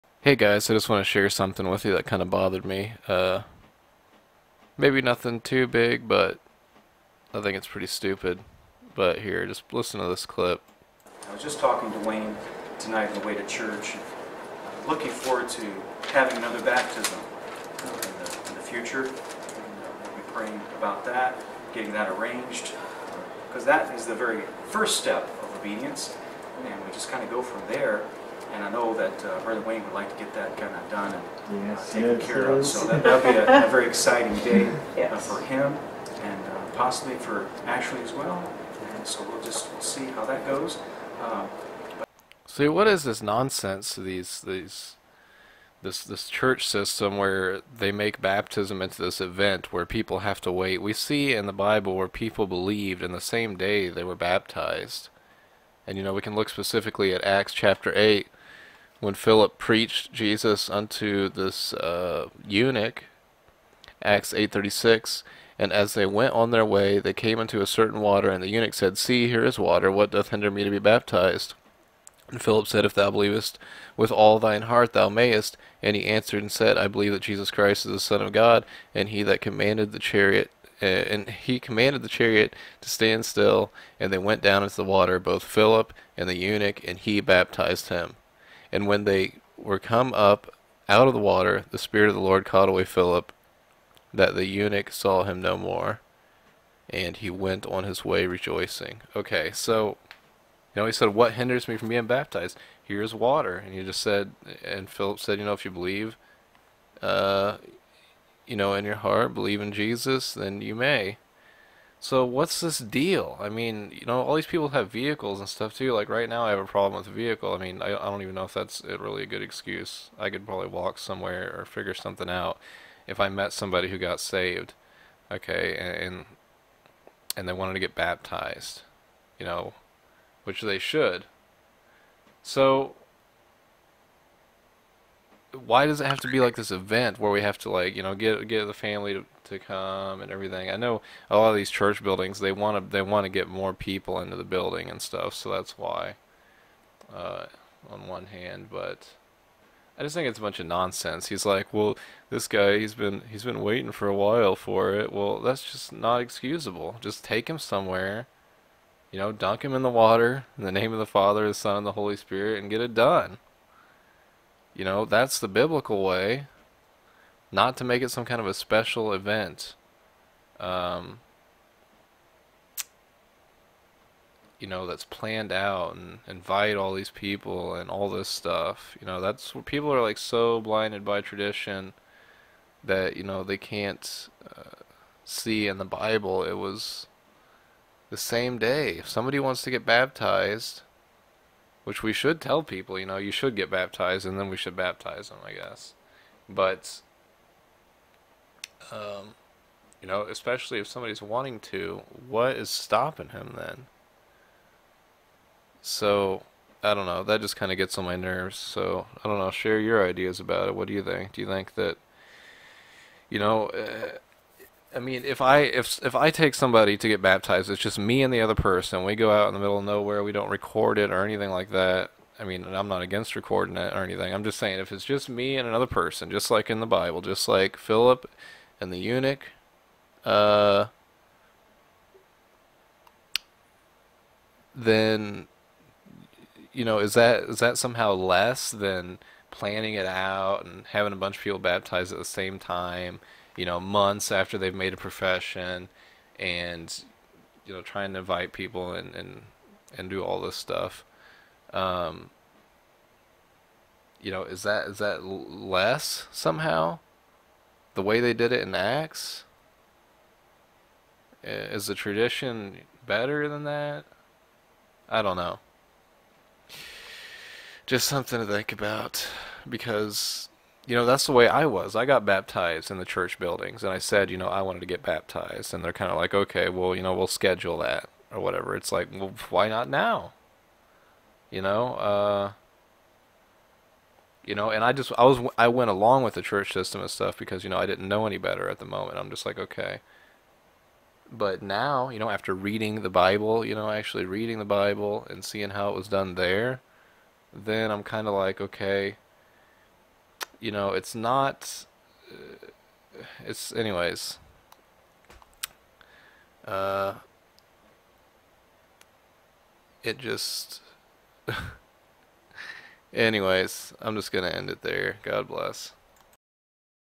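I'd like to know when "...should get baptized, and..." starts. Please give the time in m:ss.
3:13.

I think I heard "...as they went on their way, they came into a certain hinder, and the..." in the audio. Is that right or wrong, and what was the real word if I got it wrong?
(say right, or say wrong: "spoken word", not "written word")
wrong: "water", not "hinder".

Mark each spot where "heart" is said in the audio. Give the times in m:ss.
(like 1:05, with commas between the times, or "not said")
1:14, 1:48.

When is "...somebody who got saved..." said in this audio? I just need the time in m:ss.
2:03.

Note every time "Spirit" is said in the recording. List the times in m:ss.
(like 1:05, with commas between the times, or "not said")
1:31, 2:42.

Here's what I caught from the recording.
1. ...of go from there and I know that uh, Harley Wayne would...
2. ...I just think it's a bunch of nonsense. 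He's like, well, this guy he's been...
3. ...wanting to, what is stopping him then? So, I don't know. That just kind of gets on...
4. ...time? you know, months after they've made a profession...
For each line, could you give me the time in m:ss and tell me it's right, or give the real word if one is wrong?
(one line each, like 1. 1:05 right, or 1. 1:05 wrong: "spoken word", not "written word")
1. 0:27 right
2. 2:29 right
3. 3:21 right
4. 4:02 right.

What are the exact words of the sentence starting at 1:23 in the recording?
And they went down into the water, both Philip and the eunuch, and he baptized him.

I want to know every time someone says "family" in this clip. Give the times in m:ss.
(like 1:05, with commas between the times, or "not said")
2:18.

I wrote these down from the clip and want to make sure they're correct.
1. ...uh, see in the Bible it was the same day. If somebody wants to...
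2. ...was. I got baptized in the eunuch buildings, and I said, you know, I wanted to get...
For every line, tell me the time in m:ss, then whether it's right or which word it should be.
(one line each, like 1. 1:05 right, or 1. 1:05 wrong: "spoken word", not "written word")
1. 3:04 right
2. 4:31 wrong: "church", not "eunuch".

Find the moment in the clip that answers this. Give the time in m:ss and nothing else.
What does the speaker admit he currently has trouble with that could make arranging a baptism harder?
1:57.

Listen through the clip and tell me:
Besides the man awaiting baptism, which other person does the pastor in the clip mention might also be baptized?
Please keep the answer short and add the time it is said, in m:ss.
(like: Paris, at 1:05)
Ashley, at 0:37.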